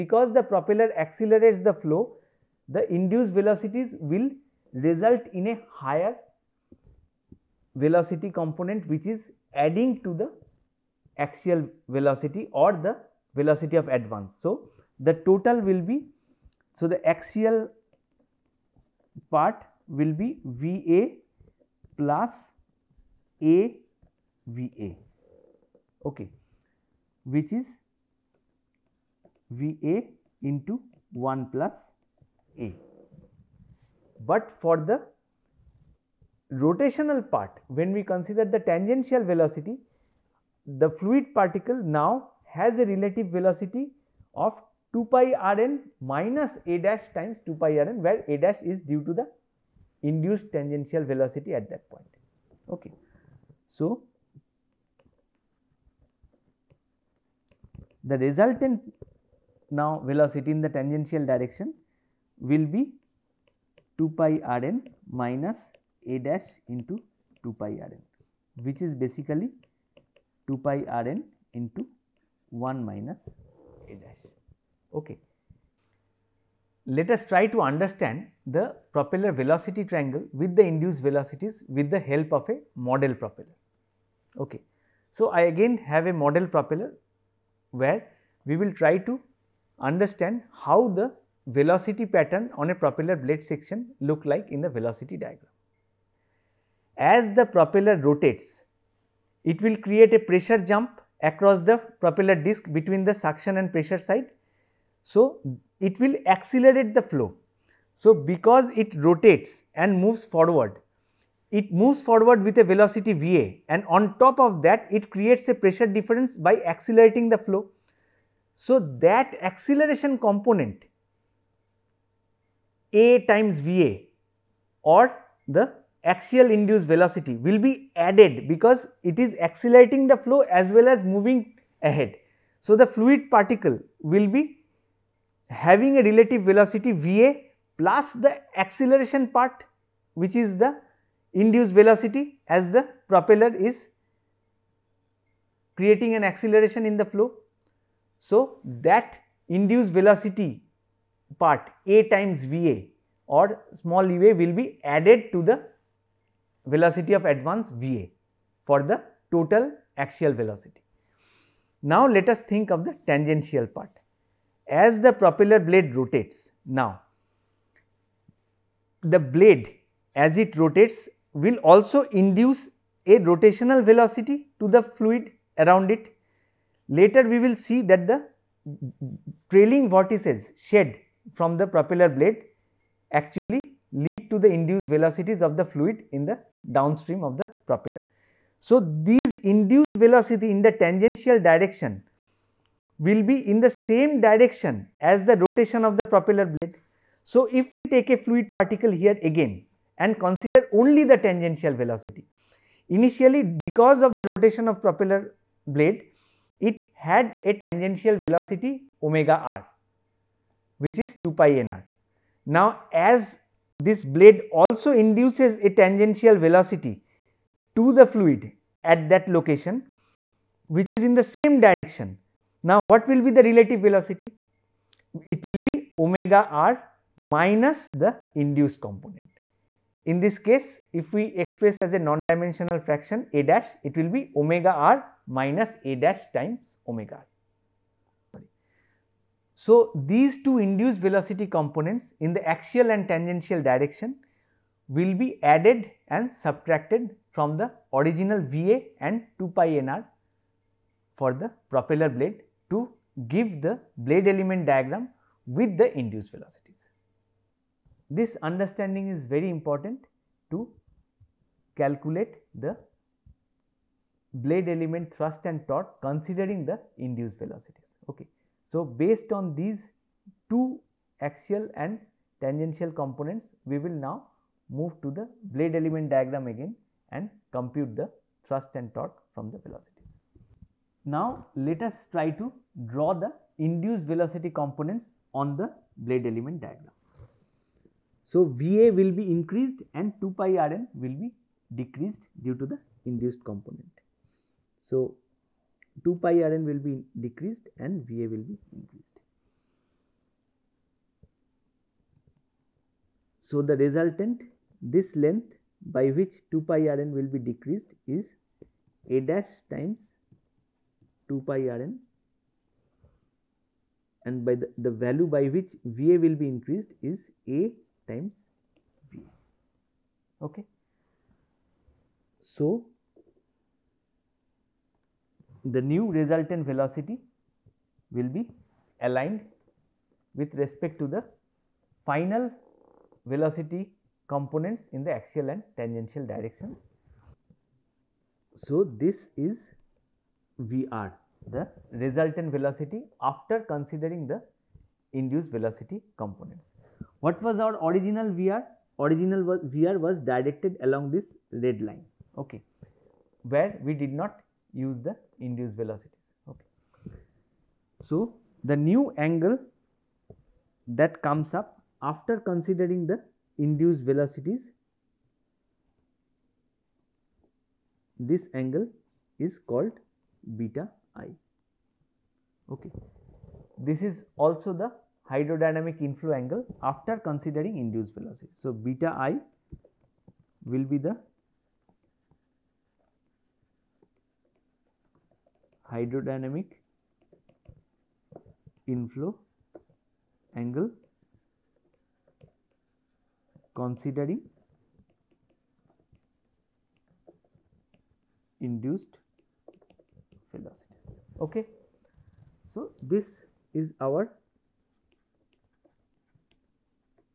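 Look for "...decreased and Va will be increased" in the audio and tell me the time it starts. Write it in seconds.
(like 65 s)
297 s.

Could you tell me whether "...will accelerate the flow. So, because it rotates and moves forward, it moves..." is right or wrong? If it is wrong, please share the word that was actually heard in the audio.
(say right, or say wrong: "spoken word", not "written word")
right.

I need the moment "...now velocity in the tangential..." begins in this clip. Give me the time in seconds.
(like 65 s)
59 s.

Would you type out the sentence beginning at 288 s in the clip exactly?
So, Va will be increased and 2 pi Rn will be decreased due to the induced component.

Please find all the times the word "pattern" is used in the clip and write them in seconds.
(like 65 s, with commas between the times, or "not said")
92 s.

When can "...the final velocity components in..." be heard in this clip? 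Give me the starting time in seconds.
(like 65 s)
331 s.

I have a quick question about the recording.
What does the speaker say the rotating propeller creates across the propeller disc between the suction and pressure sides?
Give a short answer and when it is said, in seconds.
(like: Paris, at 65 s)
a pressure jump, at 100 s.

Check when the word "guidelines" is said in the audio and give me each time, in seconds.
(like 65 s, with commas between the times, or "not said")
not said.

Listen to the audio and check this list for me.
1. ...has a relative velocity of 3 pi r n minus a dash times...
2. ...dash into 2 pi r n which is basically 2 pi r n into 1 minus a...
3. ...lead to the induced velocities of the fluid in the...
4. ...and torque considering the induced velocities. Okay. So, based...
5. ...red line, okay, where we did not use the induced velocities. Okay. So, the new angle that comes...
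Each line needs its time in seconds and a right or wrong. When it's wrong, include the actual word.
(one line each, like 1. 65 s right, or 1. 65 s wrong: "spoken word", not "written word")
1. 42 s wrong: "2", not "3"
2. 66 s right
3. 183 s right
4. 265 s right
5. 351 s right.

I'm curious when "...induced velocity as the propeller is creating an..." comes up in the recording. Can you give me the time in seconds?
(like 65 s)
141 s.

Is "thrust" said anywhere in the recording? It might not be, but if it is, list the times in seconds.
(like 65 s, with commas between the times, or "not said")
265 s, 278 s.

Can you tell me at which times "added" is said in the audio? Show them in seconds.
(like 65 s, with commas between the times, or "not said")
127 s, 154 s, 245 s.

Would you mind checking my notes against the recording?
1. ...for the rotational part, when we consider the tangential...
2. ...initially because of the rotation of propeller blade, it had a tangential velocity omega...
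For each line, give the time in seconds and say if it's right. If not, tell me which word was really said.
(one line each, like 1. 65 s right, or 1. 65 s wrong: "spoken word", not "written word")
1. 34 s right
2. 202 s right.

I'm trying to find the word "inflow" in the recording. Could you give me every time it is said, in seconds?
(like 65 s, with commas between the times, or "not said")
375 s, 388 s.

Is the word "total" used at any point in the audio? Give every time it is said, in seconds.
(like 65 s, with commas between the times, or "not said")
15 s, 159 s.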